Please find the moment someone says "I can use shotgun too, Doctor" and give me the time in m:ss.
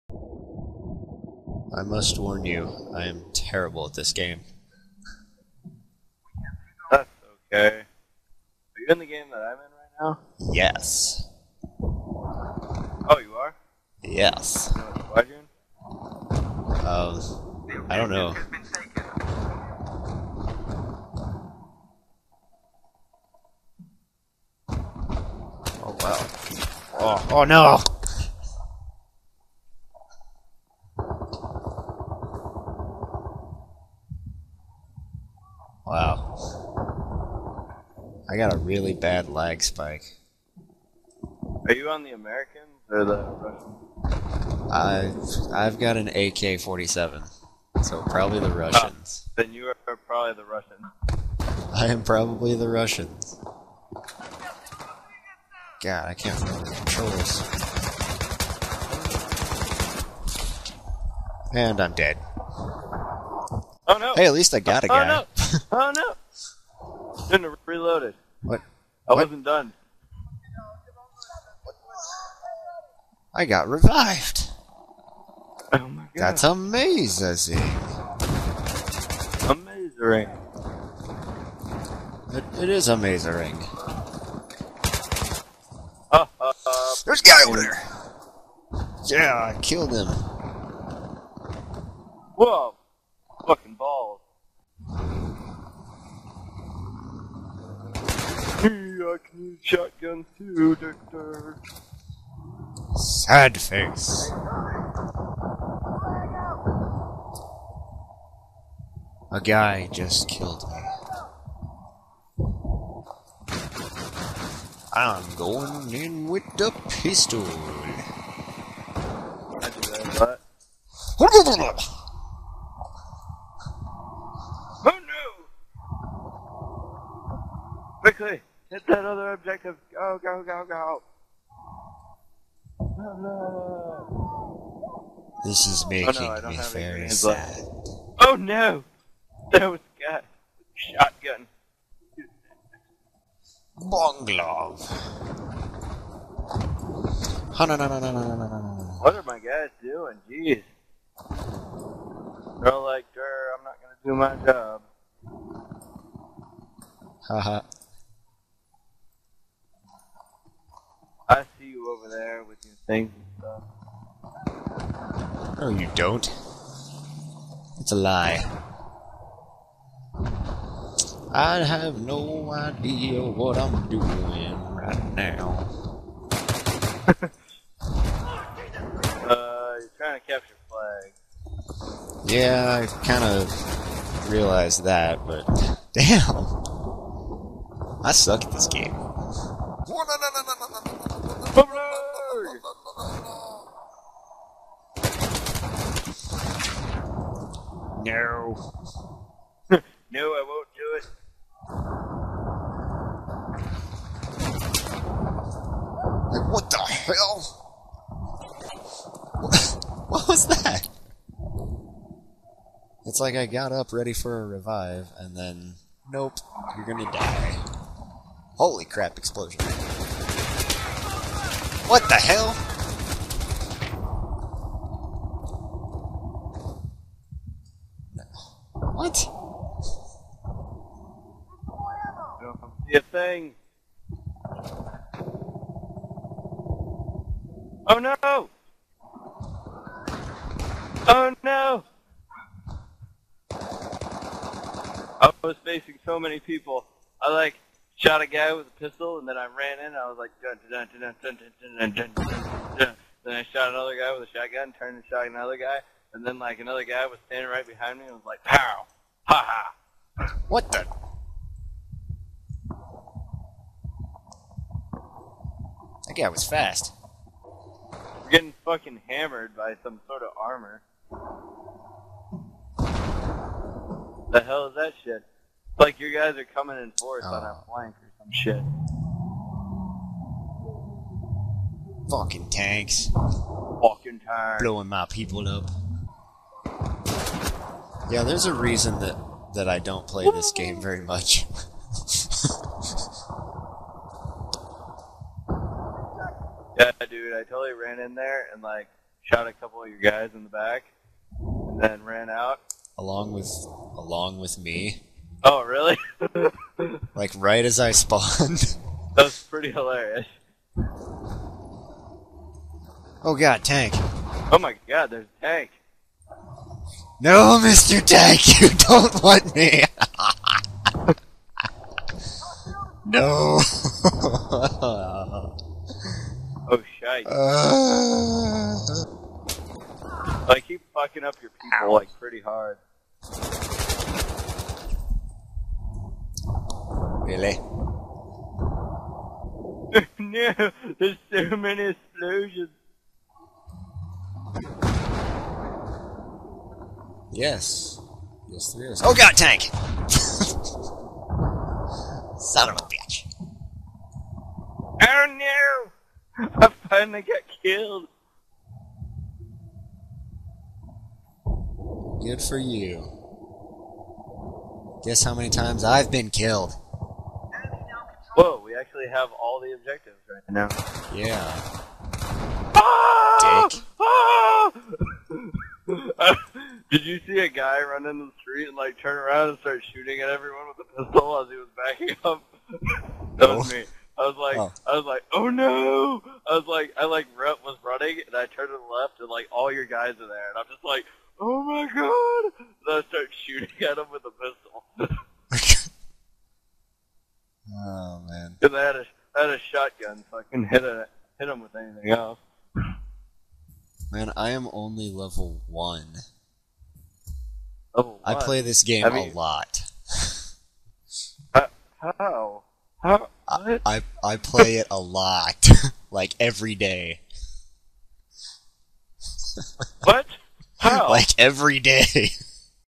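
1:39.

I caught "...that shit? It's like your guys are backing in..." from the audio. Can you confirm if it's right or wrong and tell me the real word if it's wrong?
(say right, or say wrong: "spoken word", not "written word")
wrong: "coming", not "backing".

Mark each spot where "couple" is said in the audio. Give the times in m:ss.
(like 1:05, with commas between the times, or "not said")
4:59.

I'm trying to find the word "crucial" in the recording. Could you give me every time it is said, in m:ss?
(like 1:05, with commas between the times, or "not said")
not said.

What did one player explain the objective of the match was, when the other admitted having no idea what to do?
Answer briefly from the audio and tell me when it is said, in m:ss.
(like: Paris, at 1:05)
capture flag, at 3:00.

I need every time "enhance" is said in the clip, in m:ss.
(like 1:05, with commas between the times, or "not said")
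not said.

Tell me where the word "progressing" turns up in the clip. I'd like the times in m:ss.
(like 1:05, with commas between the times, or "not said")
not said.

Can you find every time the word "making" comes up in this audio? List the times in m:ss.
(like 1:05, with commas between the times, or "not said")
2:15.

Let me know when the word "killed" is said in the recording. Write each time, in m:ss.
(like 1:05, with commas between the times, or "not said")
1:29, 1:50, 5:57, 6:06.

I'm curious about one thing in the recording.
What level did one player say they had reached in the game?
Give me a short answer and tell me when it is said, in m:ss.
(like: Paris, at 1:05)
level one, at 6:45.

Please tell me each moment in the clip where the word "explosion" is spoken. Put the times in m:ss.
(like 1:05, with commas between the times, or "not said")
3:39, 5:41.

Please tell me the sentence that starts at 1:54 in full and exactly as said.
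I'm going in with the pistol.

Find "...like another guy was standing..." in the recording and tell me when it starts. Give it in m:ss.
4:16.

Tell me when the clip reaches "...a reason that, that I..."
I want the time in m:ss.
4:48.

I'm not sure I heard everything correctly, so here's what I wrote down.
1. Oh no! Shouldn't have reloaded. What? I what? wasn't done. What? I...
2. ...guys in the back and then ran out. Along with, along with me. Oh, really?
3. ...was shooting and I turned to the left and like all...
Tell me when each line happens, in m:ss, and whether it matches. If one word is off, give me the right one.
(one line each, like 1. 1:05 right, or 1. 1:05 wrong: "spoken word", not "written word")
1. 1:05 right
2. 4:59 right
3. 6:27 wrong: "running", not "shooting".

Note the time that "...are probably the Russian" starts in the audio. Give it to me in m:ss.
0:49.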